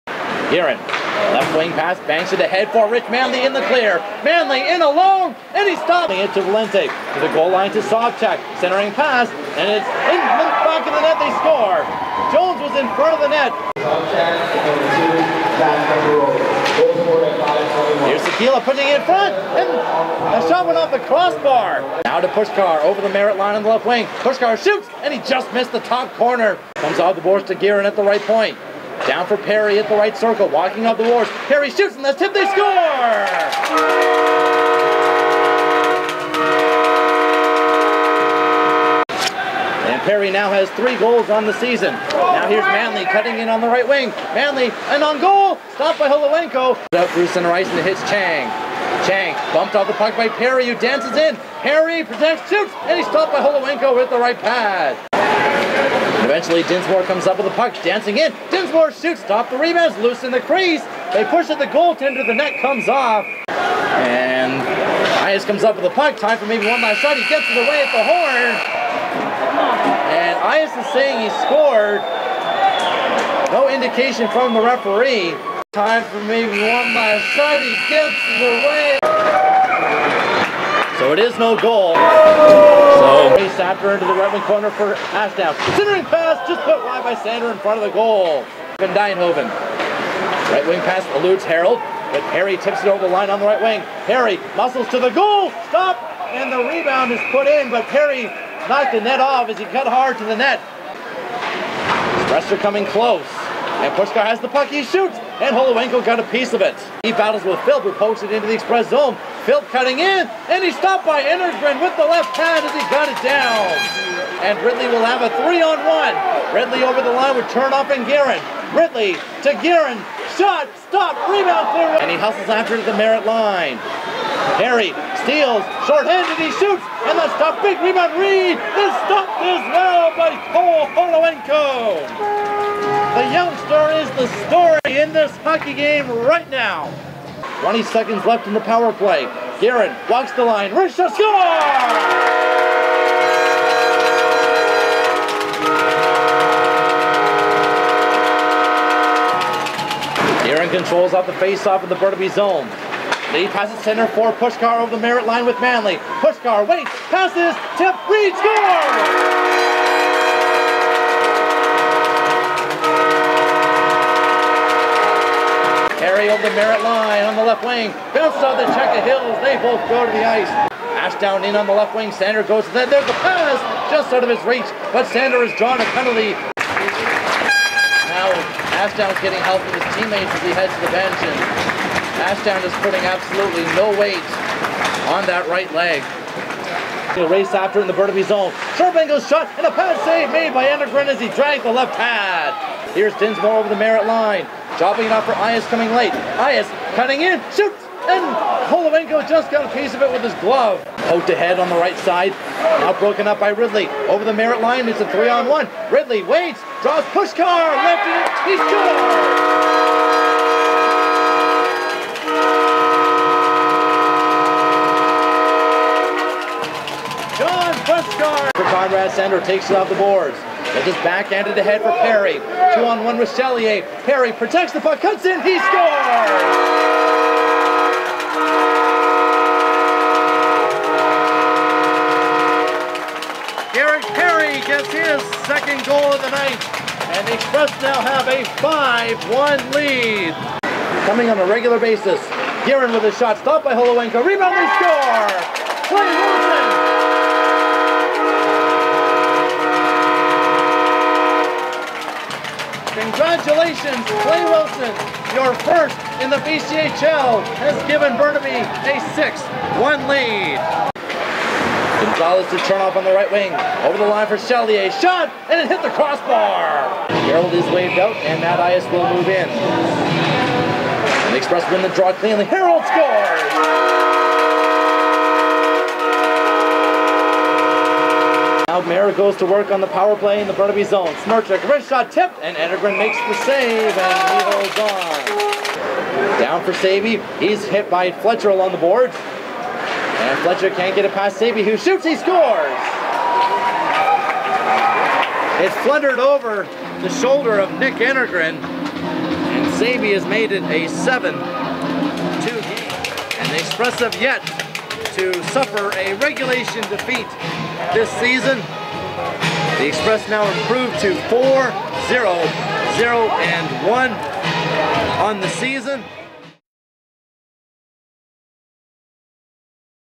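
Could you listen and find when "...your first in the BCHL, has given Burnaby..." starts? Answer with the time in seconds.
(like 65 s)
255 s.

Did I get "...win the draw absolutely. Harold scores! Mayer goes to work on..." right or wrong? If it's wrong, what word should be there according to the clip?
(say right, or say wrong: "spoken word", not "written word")
wrong: "cleanly", not "absolutely".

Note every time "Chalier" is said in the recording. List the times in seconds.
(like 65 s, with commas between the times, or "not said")
264 s.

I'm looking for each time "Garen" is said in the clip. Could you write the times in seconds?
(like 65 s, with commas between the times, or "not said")
139 s, 150 s.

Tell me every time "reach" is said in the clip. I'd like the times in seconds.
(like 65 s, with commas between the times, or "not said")
174 s.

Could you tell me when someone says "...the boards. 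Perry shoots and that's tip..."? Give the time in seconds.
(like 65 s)
30 s.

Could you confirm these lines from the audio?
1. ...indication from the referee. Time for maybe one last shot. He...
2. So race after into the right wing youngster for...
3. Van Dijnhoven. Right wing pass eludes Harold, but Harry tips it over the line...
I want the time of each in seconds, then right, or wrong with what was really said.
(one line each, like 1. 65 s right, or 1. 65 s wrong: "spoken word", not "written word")
1. 73 s right
2. 81 s wrong: "corner", not "youngster"
3. 88 s right.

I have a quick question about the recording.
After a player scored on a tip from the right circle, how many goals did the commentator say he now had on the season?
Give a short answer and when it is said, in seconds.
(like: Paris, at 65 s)
3, at 40 s.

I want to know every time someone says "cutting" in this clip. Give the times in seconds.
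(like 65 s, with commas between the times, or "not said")
43 s, 109 s, 196 s.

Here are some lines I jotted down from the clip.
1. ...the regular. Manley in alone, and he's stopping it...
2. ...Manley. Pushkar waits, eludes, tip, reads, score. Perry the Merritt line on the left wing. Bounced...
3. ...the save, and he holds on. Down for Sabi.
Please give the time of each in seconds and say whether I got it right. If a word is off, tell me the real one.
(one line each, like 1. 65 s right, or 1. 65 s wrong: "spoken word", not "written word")
1. 3 s wrong: "clear", not "regular"
2. 155 s wrong: "passes", not "eludes"
3. 283 s right.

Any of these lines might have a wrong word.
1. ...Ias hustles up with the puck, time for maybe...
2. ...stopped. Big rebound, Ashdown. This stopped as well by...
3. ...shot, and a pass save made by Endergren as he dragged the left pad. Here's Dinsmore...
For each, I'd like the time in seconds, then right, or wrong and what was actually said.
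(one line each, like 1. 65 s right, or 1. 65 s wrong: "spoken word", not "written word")
1. 65 s wrong: "comes", not "hustles"
2. 127 s wrong: "Reed", not "Ashdown"
3. 189 s right.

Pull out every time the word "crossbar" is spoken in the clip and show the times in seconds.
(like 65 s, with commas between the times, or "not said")
21 s, 265 s.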